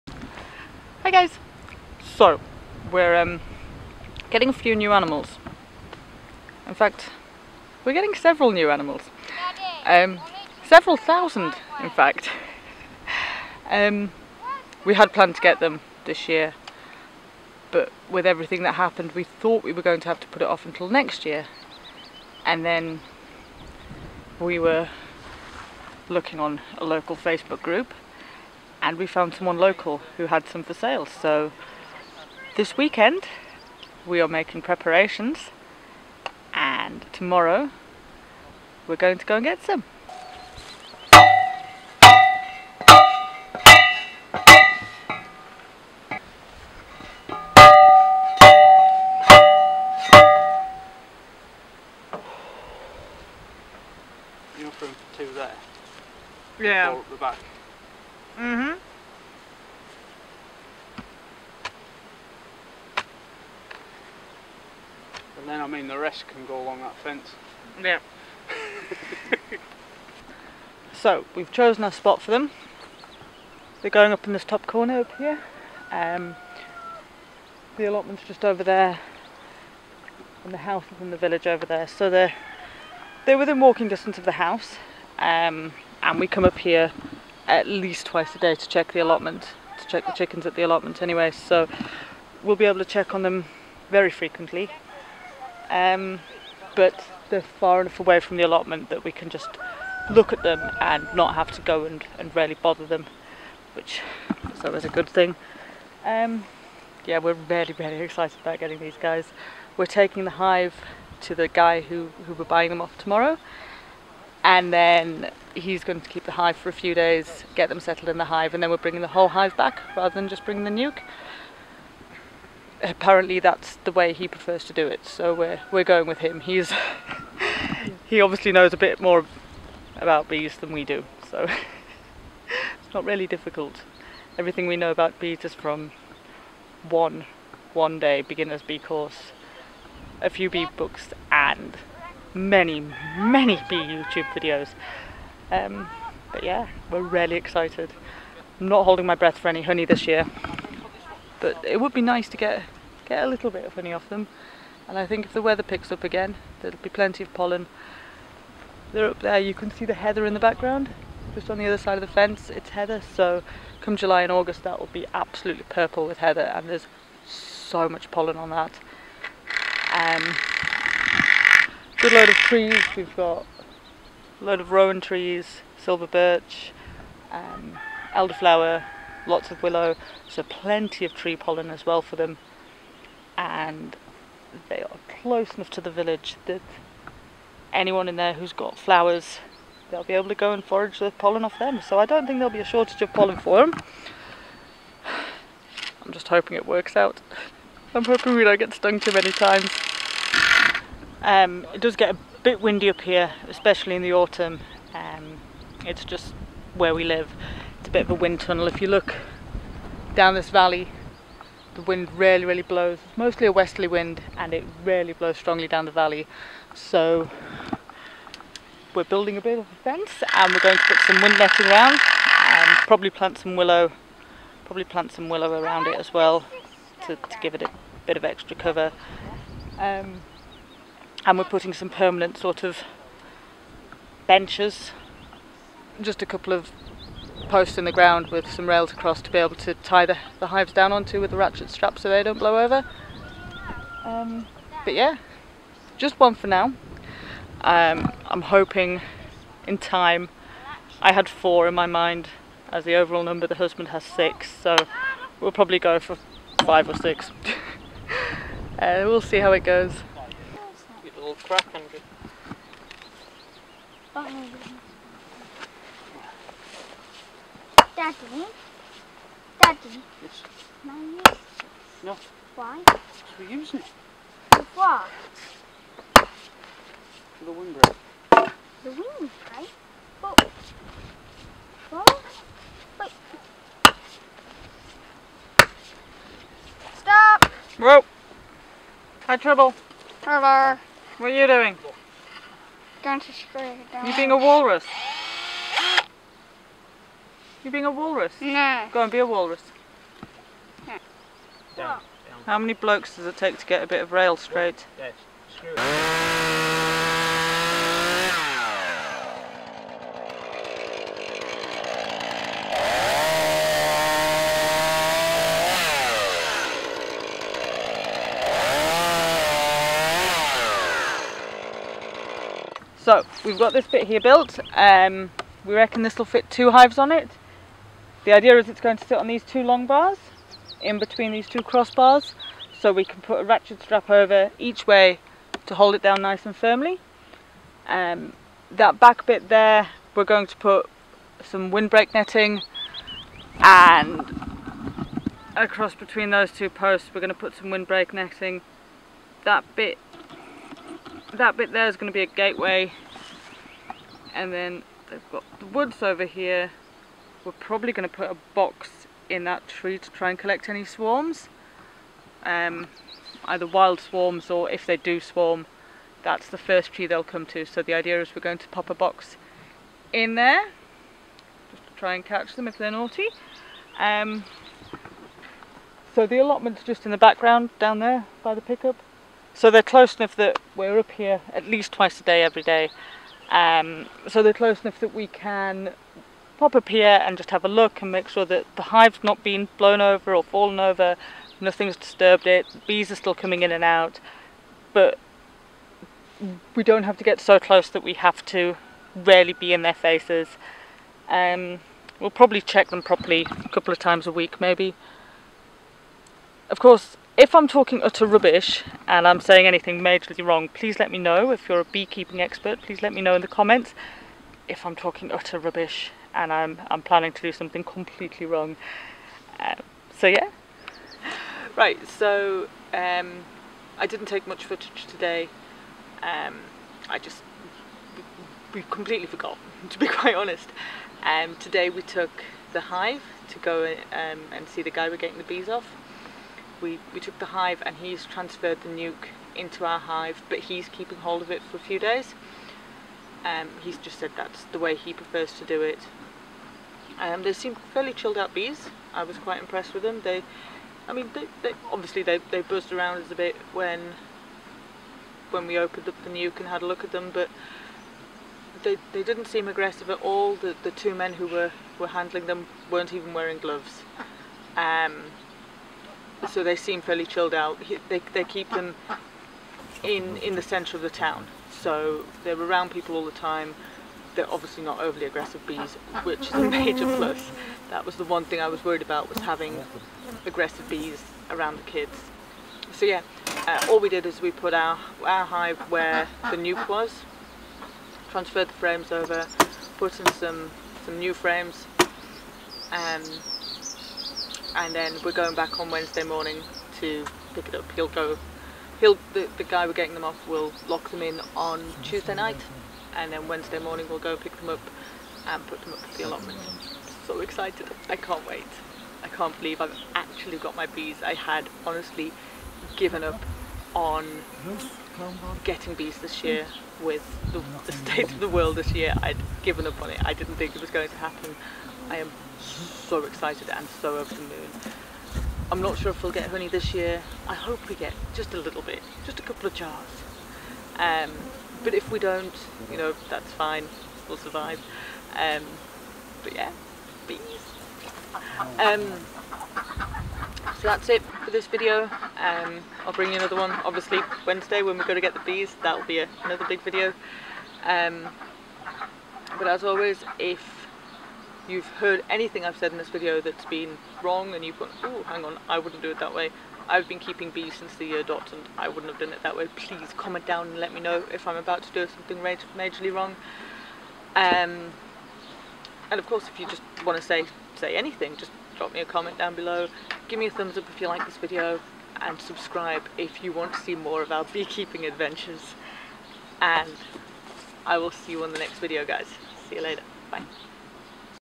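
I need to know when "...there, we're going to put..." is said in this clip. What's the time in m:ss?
5:39.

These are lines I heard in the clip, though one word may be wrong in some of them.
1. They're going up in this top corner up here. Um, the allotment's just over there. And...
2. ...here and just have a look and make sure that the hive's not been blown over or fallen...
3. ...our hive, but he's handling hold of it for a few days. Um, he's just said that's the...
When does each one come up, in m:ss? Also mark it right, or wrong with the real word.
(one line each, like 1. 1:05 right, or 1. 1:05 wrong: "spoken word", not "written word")
1. 1:13 right
2. 6:26 right
3. 7:19 wrong: "keeping", not "handling".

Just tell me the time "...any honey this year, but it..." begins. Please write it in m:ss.
2:29.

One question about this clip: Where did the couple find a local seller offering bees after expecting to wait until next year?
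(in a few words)
Local Facebook group.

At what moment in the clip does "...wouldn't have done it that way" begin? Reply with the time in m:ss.
9:18.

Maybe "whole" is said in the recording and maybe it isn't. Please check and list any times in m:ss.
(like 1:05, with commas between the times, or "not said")
1:59.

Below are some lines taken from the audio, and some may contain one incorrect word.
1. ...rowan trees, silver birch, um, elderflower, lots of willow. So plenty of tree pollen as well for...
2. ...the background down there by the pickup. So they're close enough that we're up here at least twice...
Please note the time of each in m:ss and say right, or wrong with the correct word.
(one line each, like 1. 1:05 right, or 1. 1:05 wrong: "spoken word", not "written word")
1. 2:54 right
2. 6:17 right.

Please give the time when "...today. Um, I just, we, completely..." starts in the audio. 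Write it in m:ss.
7:05.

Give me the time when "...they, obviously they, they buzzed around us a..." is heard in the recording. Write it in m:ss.
7:31.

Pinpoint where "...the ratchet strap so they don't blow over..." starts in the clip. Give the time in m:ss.
4:01.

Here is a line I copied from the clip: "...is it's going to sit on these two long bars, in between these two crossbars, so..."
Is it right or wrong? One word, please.
right.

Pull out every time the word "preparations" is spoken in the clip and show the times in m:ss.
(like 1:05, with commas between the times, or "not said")
0:34.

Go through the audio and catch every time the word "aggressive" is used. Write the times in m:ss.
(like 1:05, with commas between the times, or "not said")
7:39, 7:55, 8:00.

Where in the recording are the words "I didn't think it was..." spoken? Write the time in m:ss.
8:40.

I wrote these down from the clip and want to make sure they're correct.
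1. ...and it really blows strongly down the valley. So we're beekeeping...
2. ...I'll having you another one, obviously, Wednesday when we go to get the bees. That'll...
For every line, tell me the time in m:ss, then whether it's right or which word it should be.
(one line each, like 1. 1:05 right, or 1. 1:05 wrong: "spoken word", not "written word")
1. 3:34 wrong: "building", not "beekeeping"
2. 9:03 wrong: "bring", not "having".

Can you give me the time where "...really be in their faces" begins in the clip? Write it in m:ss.
6:39.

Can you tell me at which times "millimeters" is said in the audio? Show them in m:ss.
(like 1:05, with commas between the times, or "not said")
not said.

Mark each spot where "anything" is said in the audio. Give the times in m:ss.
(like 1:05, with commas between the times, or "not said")
6:49, 9:12, 9:27.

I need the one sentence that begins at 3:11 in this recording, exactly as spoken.
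So I don't think there'll be a shortage of pollen for them.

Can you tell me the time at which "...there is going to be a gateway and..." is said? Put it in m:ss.
5:51.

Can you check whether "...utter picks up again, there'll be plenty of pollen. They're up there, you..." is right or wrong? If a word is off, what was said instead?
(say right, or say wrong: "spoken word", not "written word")
wrong: "weather", not "utter".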